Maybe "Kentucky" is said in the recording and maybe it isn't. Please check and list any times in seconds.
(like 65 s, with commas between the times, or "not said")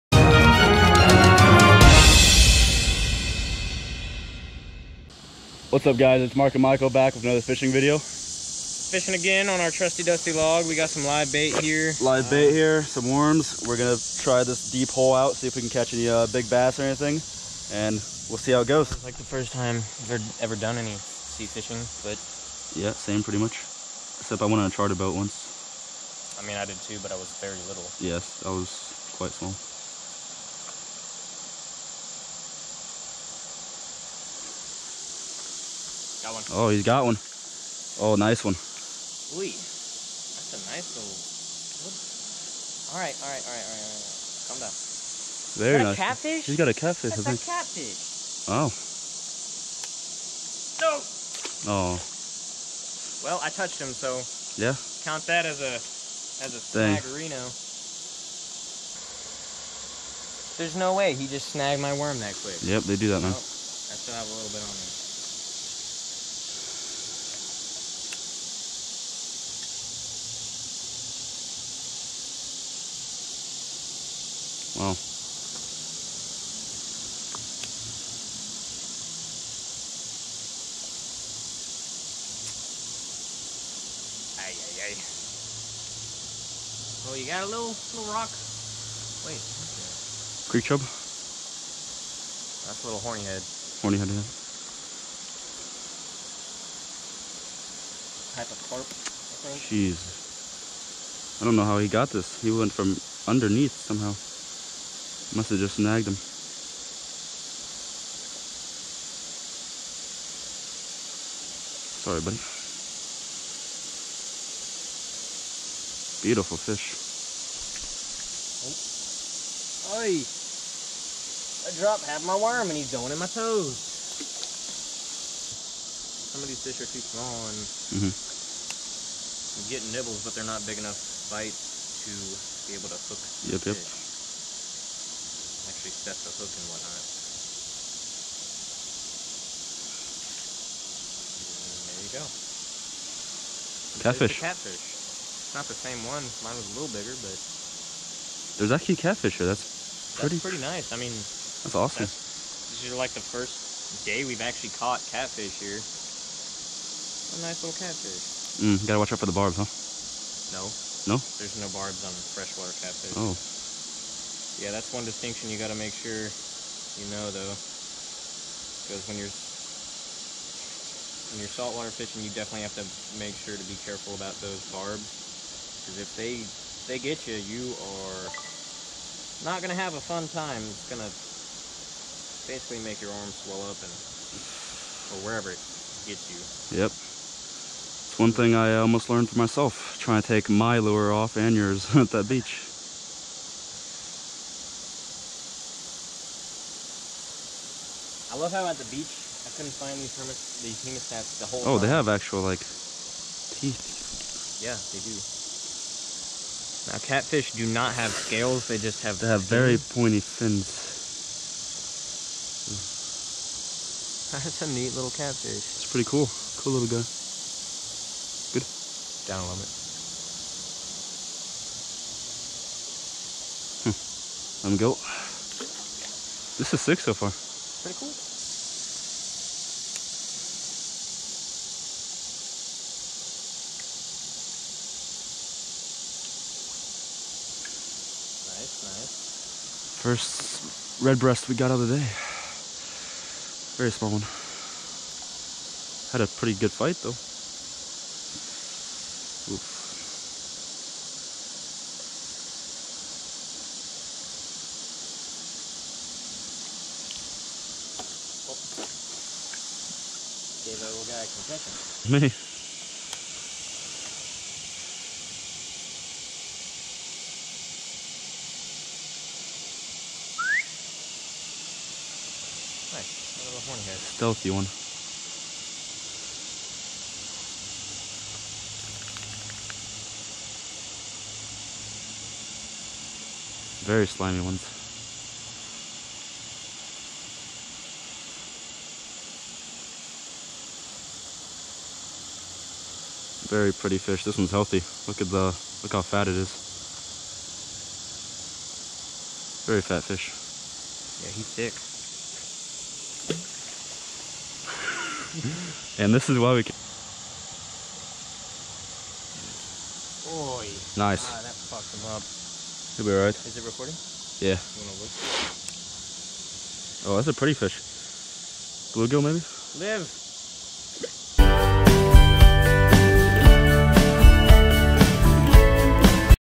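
not said.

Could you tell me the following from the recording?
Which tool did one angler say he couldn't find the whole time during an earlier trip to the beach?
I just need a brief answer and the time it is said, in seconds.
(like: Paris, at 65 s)
hemostats, at 200 s.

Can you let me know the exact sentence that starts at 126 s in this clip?
Some of these fish are too small and mm -hmm.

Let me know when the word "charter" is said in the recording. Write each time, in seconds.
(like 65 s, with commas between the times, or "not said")
24 s.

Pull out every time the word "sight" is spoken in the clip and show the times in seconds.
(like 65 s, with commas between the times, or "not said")
not said.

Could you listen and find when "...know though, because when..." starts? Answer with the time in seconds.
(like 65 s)
167 s.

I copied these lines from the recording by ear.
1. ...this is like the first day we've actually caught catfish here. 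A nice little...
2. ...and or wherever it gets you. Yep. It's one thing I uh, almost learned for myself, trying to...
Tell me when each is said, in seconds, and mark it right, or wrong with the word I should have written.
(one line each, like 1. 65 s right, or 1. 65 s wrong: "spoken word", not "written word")
1. 152 s right
2. 183 s right.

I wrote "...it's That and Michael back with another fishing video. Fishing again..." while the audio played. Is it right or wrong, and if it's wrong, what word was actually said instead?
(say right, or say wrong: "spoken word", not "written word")
wrong: "Mark", not "That".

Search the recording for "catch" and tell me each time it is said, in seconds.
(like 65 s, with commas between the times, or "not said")
15 s.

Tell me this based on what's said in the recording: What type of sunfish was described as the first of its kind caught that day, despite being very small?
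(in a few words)
red breast.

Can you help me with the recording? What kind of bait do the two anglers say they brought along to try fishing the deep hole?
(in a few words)
worms.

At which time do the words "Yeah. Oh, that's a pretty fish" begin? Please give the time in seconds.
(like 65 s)
314 s.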